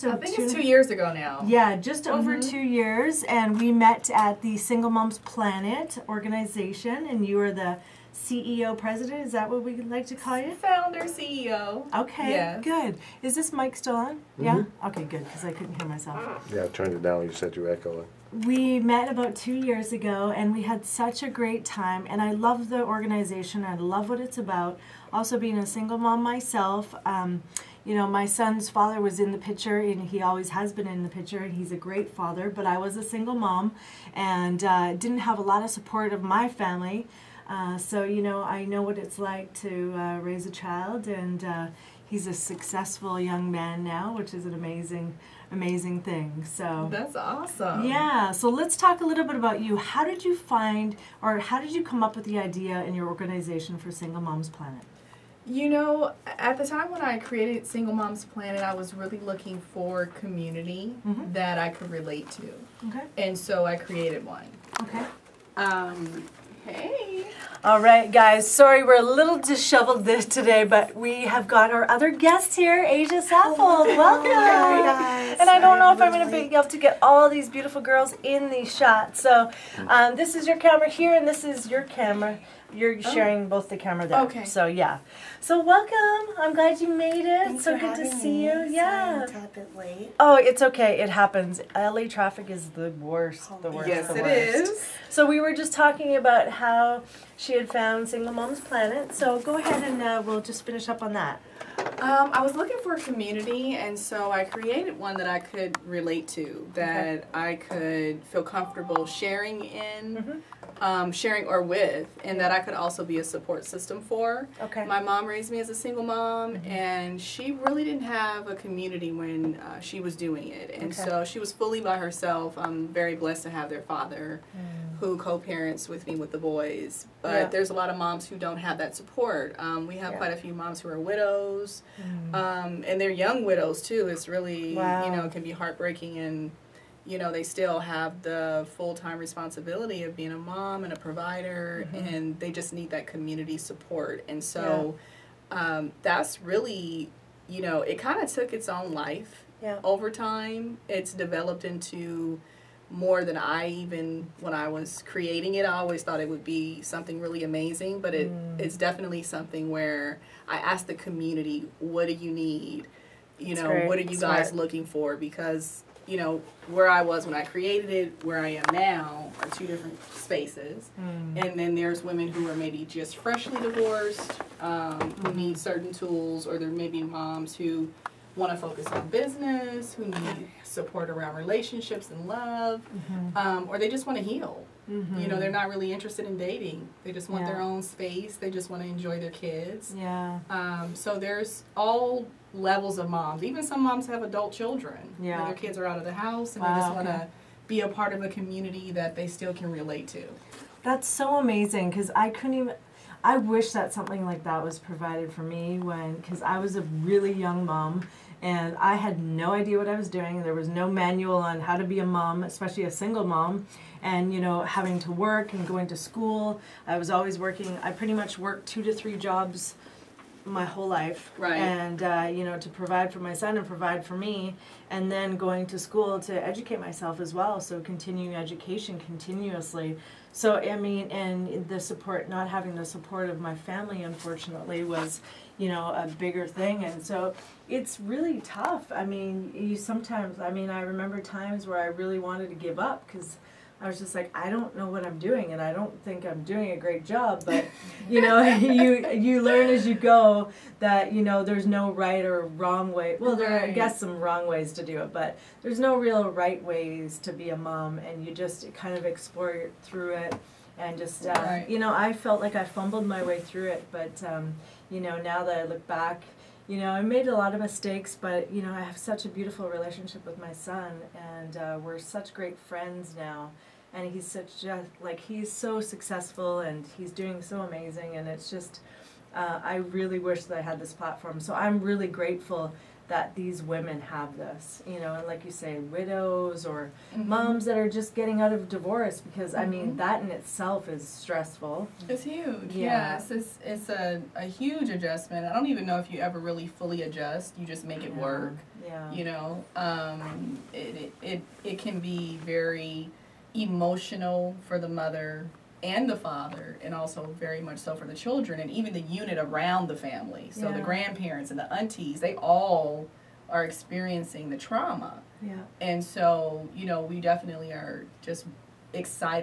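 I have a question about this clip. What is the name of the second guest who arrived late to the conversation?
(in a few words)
Asia Saffold.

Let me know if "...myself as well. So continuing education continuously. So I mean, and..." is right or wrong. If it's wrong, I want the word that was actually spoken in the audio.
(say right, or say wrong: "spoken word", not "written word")
right.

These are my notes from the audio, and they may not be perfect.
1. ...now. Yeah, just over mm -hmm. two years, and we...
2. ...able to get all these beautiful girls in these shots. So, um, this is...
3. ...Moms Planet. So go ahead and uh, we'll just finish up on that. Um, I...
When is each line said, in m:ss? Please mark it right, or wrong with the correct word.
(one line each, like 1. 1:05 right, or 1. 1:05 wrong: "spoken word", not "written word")
1. 0:01 right
2. 1:16 right
3. 1:38 right.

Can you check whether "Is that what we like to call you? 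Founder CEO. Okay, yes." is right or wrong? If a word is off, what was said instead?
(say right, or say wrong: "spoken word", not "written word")
right.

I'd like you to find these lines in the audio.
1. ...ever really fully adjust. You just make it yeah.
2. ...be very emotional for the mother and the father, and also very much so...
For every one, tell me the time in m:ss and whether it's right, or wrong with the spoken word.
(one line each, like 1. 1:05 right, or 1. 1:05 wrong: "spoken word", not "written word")
1. 4:56 right
2. 5:01 right.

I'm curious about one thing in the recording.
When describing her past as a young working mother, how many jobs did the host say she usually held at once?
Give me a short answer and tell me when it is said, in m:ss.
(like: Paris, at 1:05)
2 to 3, at 3:38.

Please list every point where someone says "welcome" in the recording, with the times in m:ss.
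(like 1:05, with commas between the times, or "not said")
1:13, 1:25.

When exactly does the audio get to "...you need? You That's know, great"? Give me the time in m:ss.
2:42.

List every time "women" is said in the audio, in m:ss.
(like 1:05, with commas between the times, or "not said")
2:52, 4:43.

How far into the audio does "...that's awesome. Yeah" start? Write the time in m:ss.
0:46.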